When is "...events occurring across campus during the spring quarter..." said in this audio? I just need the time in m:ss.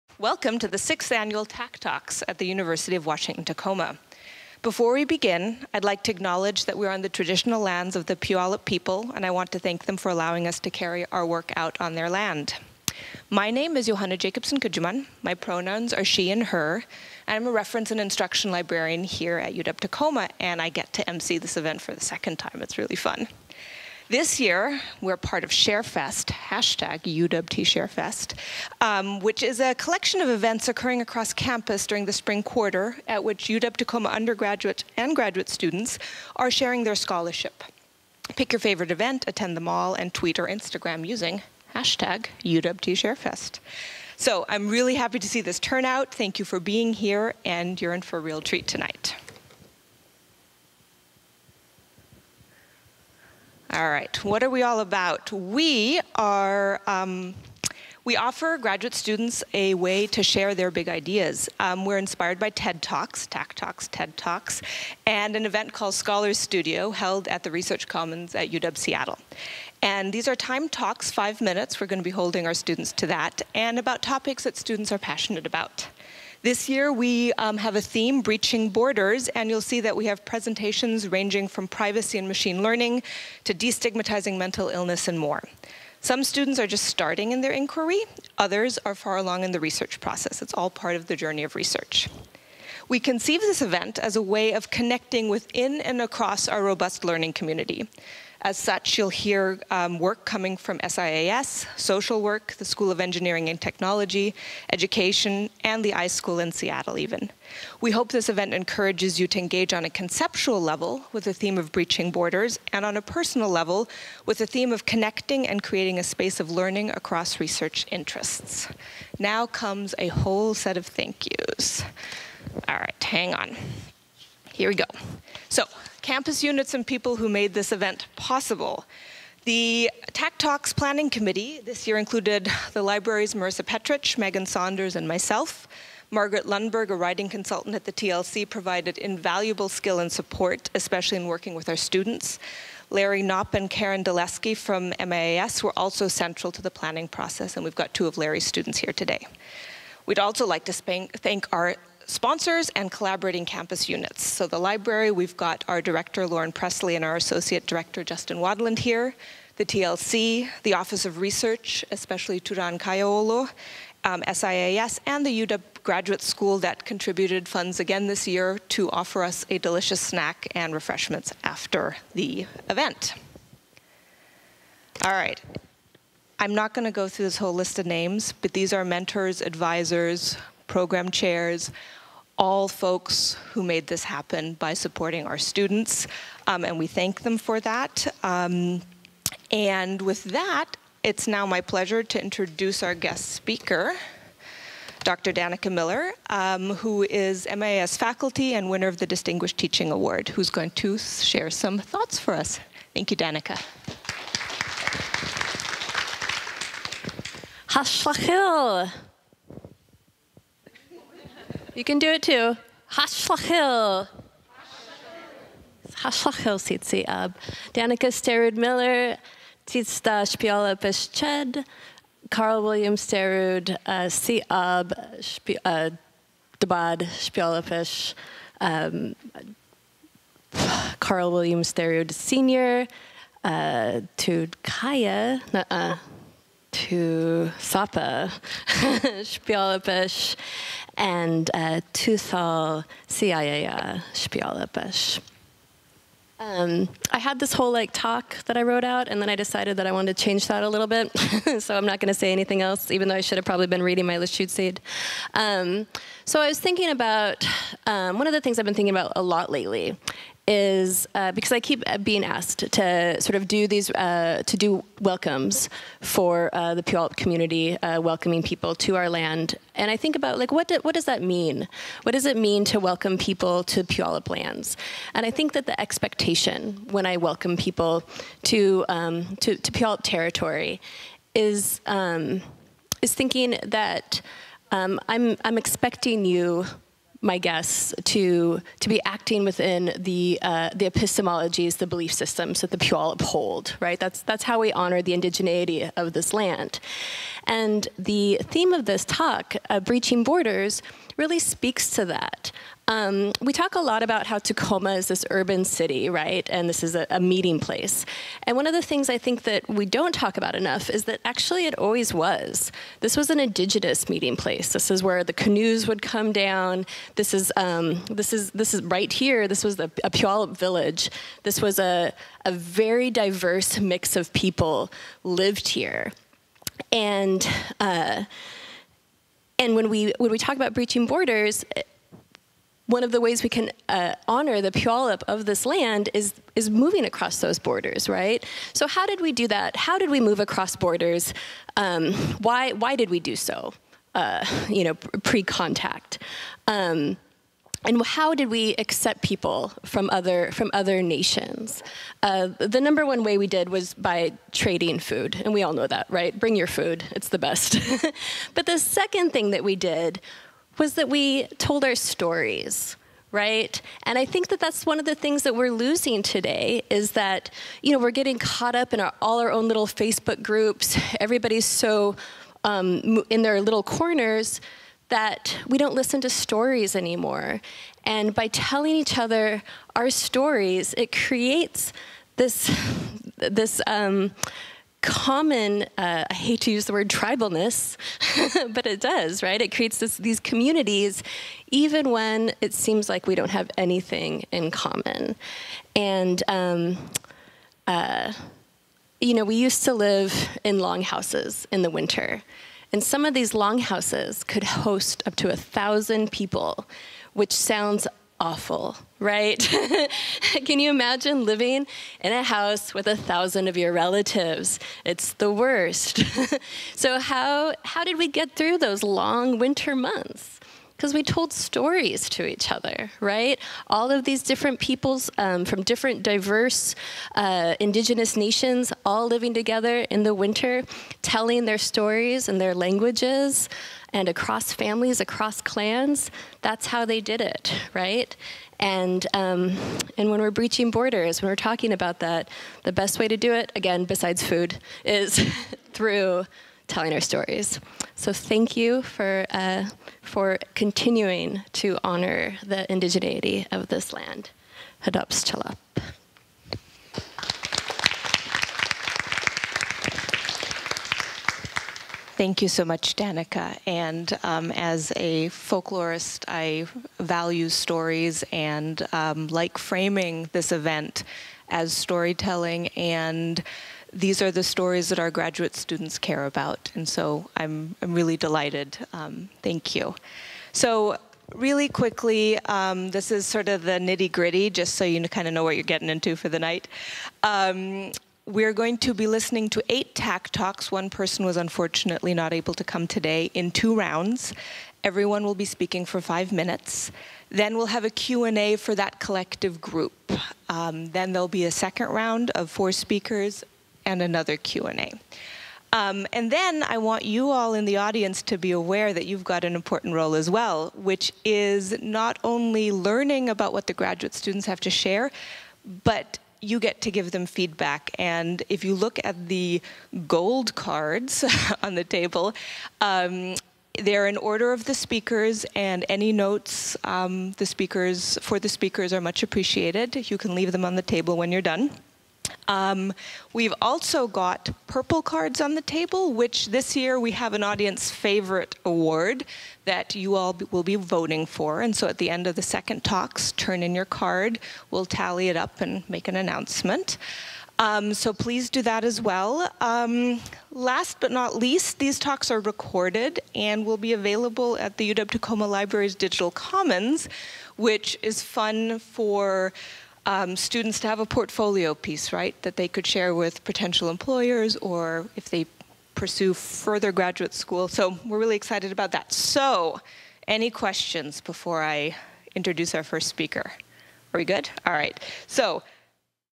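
0:30.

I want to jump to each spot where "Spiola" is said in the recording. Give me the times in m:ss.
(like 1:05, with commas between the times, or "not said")
3:40, 3:47.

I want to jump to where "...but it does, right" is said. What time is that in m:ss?
6:28.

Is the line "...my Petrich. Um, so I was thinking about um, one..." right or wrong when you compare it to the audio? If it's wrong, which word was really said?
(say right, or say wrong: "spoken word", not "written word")
wrong: "Lushootseed", not "Petrich".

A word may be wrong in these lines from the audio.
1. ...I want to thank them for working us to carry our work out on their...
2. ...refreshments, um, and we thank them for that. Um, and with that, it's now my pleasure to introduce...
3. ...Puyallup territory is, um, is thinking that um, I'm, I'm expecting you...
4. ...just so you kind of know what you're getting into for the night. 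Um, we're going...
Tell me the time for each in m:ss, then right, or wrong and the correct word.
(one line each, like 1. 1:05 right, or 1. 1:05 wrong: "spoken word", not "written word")
1. 0:09 wrong: "allowing", not "working"
2. 3:05 wrong: "students", not "refreshments"
3. 4:39 right
4. 8:04 right.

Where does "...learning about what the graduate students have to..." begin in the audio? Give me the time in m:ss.
8:32.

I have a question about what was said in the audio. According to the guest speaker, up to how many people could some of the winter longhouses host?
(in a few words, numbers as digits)
1,000.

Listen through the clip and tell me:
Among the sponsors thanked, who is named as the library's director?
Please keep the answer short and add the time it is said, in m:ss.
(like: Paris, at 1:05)
Lauren Pressley, at 2:36.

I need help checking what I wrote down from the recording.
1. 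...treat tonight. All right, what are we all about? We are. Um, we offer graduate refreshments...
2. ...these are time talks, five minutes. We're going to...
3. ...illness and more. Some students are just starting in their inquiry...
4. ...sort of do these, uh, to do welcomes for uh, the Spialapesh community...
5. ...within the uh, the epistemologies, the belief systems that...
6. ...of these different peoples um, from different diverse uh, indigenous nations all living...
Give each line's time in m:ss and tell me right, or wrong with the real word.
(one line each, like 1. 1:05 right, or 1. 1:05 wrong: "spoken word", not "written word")
1. 0:48 wrong: "students", not "refreshments"
2. 1:10 right
3. 1:24 right
4. 4:23 wrong: "Puyallup", not "Spialapesh"
5. 4:49 right
6. 7:04 right.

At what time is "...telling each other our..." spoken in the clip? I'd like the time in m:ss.
6:18.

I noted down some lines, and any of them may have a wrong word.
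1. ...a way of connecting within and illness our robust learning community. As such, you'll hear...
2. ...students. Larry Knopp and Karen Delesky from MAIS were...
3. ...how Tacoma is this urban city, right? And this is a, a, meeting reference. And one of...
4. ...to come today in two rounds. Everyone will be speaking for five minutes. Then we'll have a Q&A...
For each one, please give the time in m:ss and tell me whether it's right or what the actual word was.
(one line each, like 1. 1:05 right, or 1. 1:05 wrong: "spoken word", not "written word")
1. 1:34 wrong: "across", not "illness"
2. 2:21 right
3. 5:04 wrong: "place", not "reference"
4. 8:12 right.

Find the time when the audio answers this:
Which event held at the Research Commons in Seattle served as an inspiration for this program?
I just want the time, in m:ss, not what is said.
1:05.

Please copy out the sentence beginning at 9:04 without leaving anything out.
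We'll tally it up and make an announcement.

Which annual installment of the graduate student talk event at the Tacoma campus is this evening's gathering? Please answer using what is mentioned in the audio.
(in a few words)
sixth.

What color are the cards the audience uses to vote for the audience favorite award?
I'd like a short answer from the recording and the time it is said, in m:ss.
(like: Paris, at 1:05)
purple, at 8:54.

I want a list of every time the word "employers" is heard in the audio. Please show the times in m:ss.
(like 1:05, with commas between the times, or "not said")
9:24.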